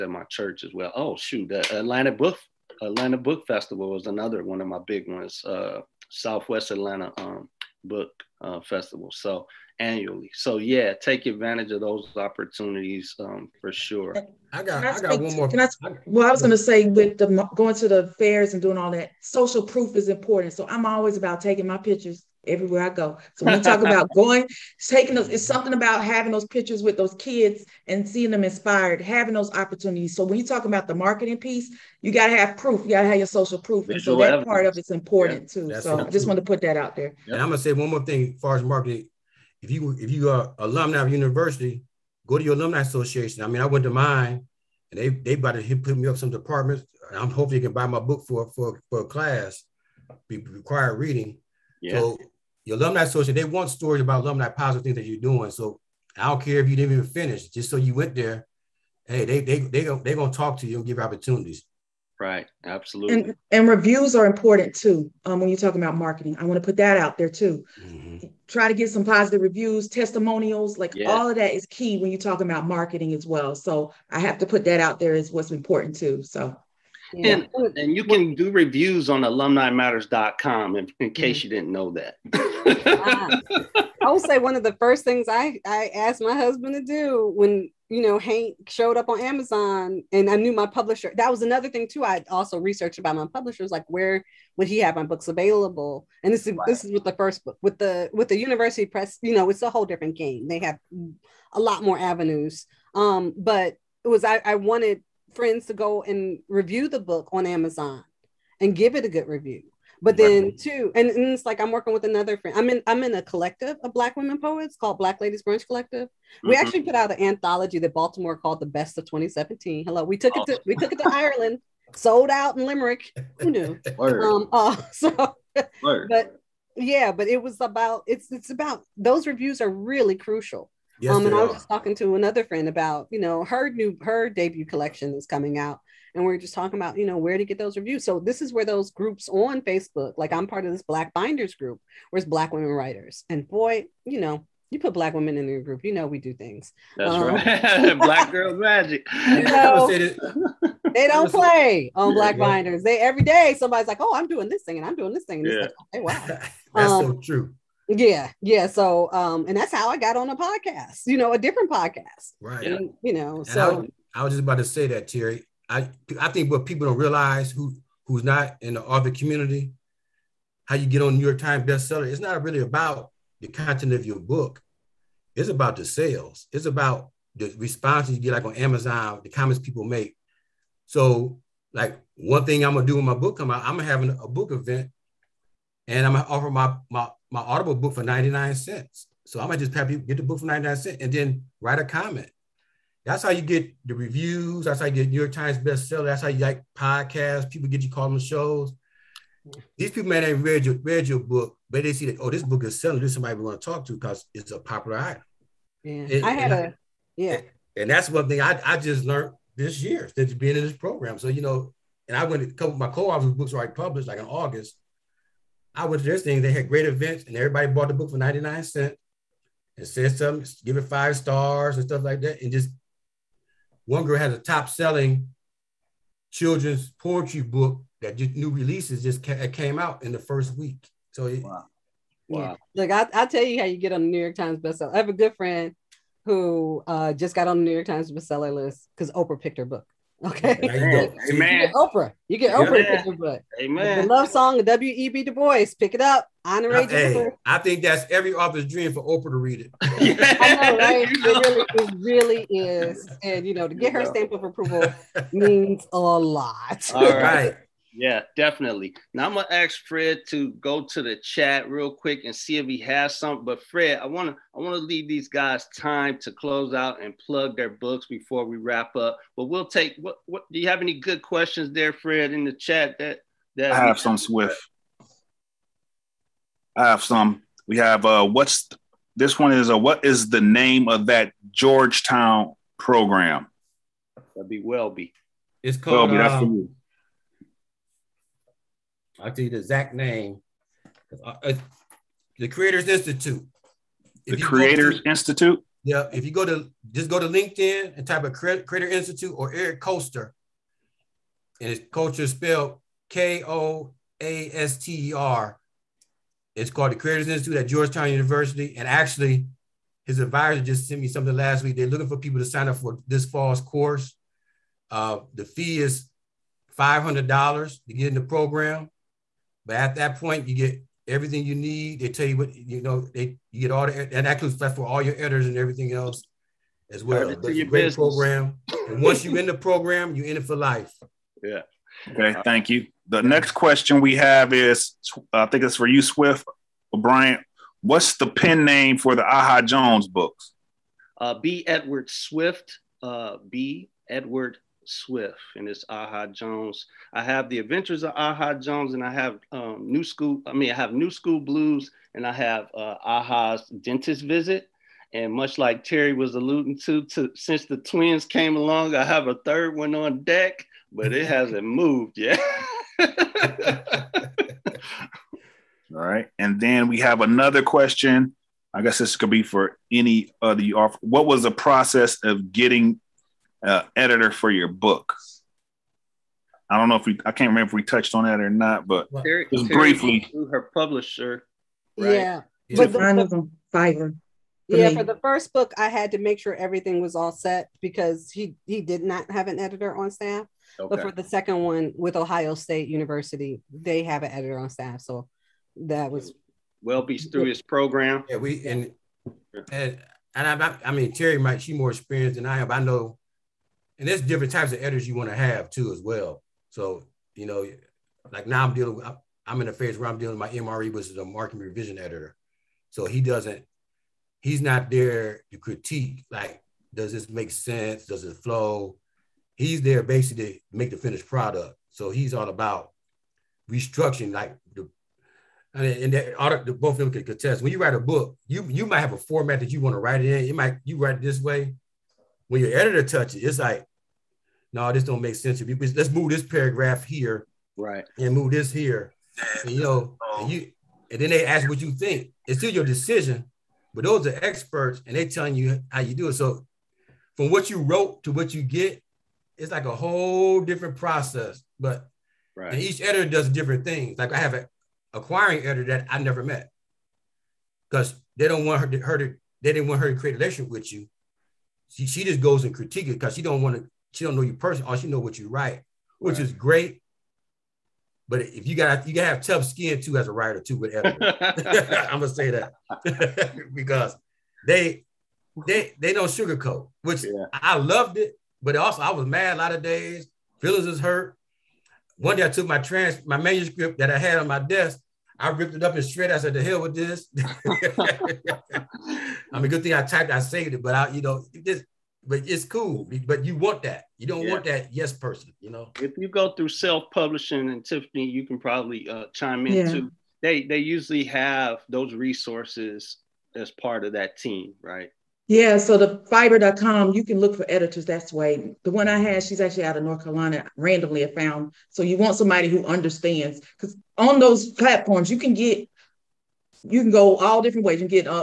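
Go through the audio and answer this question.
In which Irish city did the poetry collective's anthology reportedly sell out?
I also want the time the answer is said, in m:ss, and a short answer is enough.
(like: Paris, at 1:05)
Limerick, at 2:02.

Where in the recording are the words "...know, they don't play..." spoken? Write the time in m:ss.
2:29.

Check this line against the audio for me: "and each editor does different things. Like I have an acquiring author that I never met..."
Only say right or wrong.
wrong.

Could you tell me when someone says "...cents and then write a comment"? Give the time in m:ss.
3:10.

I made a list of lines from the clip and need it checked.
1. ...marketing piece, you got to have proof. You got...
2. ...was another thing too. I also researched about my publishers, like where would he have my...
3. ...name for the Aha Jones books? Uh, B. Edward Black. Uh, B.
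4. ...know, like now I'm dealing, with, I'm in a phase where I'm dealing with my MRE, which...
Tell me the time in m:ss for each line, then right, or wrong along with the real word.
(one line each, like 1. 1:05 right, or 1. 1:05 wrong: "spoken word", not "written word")
1. 0:30 right
2. 1:31 right
3. 5:38 wrong: "Swift", not "Black"
4. 6:47 right.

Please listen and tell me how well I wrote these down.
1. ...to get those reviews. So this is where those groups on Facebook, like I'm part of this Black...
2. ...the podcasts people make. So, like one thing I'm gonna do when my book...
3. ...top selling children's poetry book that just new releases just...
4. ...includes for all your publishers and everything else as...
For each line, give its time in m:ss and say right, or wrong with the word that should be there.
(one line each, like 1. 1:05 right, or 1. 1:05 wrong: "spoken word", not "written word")
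1. 2:17 right
2. 2:59 wrong: "comments", not "podcasts"
3. 3:44 right
4. 5:24 wrong: "editors", not "publishers".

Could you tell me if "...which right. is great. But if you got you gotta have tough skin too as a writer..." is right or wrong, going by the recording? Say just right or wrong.
right.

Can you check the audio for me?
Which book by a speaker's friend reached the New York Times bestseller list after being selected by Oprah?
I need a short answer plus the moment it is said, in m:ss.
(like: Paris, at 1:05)
The Love Song of W.E.B. Du Bois, at 4:04.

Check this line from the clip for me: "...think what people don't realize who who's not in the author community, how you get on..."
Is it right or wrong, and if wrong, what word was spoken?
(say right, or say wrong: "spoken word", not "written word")
right.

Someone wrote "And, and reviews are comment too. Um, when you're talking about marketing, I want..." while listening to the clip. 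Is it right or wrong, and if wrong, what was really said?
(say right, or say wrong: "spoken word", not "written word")
wrong: "important", not "comment".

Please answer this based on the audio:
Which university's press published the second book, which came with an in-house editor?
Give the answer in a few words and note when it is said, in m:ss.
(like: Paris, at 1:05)
Ohio State University, at 6:32.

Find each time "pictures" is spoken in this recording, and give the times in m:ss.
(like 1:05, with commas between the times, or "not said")
0:21, 0:26.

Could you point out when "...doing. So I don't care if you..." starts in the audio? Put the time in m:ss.
0:55.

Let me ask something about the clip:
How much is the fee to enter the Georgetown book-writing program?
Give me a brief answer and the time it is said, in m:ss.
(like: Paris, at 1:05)
$500, at 5:16.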